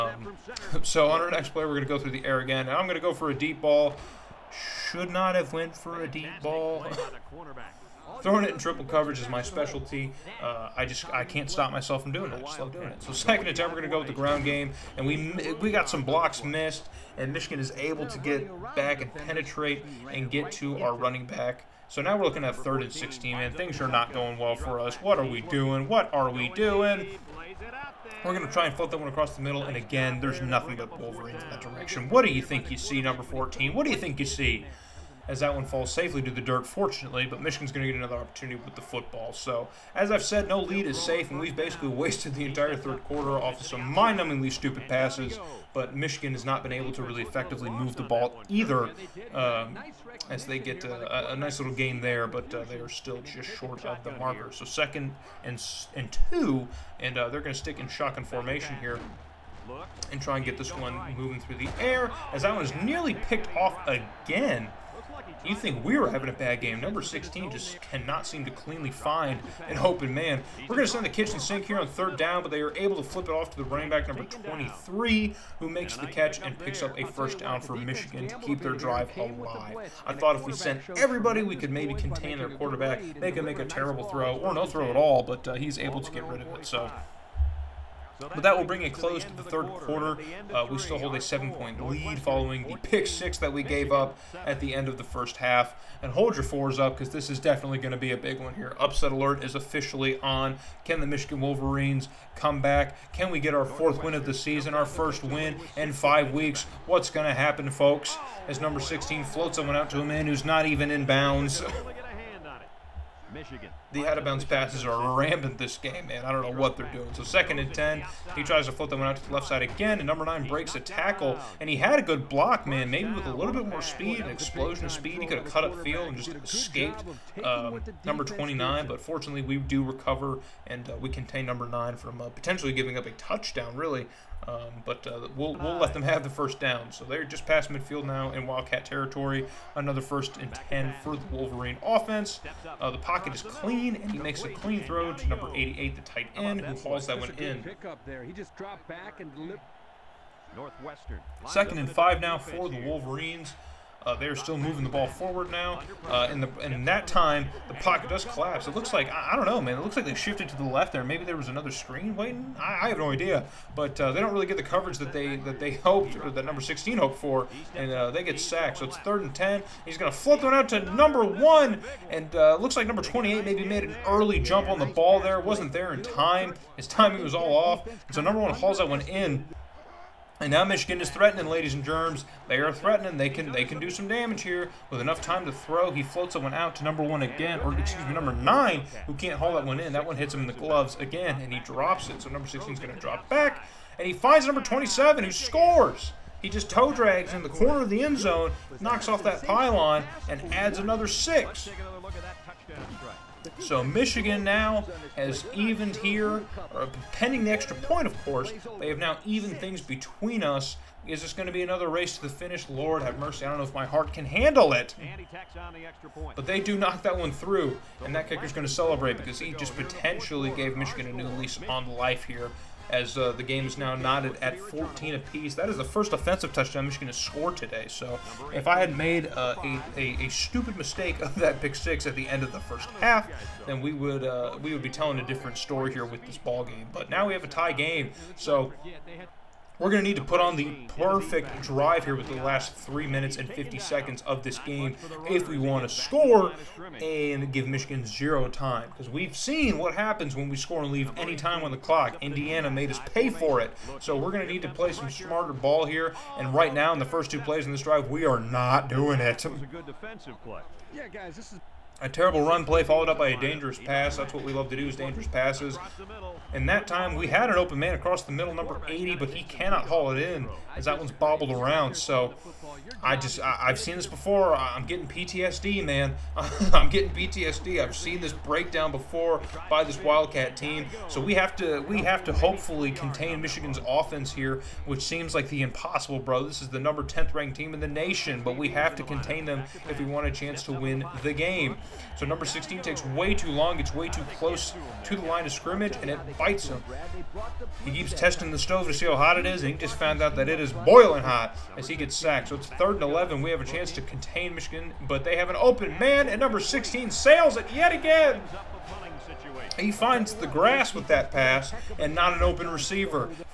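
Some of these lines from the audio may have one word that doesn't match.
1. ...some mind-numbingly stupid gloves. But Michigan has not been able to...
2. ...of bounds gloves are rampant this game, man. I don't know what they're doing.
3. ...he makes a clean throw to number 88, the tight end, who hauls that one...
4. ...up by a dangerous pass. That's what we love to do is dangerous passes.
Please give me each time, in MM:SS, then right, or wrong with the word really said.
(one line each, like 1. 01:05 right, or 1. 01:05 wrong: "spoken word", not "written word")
1. 00:43 wrong: "passes", not "gloves"
2. 01:54 wrong: "passes", not "gloves"
3. 02:24 right
4. 04:23 right.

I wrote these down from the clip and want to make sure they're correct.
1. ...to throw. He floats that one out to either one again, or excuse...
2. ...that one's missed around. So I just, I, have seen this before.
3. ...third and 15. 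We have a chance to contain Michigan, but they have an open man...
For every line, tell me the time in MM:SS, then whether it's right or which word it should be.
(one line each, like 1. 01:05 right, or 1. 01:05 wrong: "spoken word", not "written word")
1. 03:05 wrong: "number", not "either"
2. 04:30 wrong: "bobbled", not "missed"
3. 05:02 wrong: "11", not "15".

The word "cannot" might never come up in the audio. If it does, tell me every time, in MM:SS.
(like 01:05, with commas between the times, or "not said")
01:07, 04:29.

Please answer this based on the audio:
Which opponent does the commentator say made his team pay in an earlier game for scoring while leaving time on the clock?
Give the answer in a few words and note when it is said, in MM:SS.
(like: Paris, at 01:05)
Indiana, at 04:12.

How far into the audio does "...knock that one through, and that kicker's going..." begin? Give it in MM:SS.
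03:36.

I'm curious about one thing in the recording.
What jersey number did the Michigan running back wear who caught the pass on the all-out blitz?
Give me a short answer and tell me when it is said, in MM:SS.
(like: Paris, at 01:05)
23, at 01:14.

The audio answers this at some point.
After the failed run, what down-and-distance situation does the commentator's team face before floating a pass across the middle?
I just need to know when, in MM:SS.
00:22.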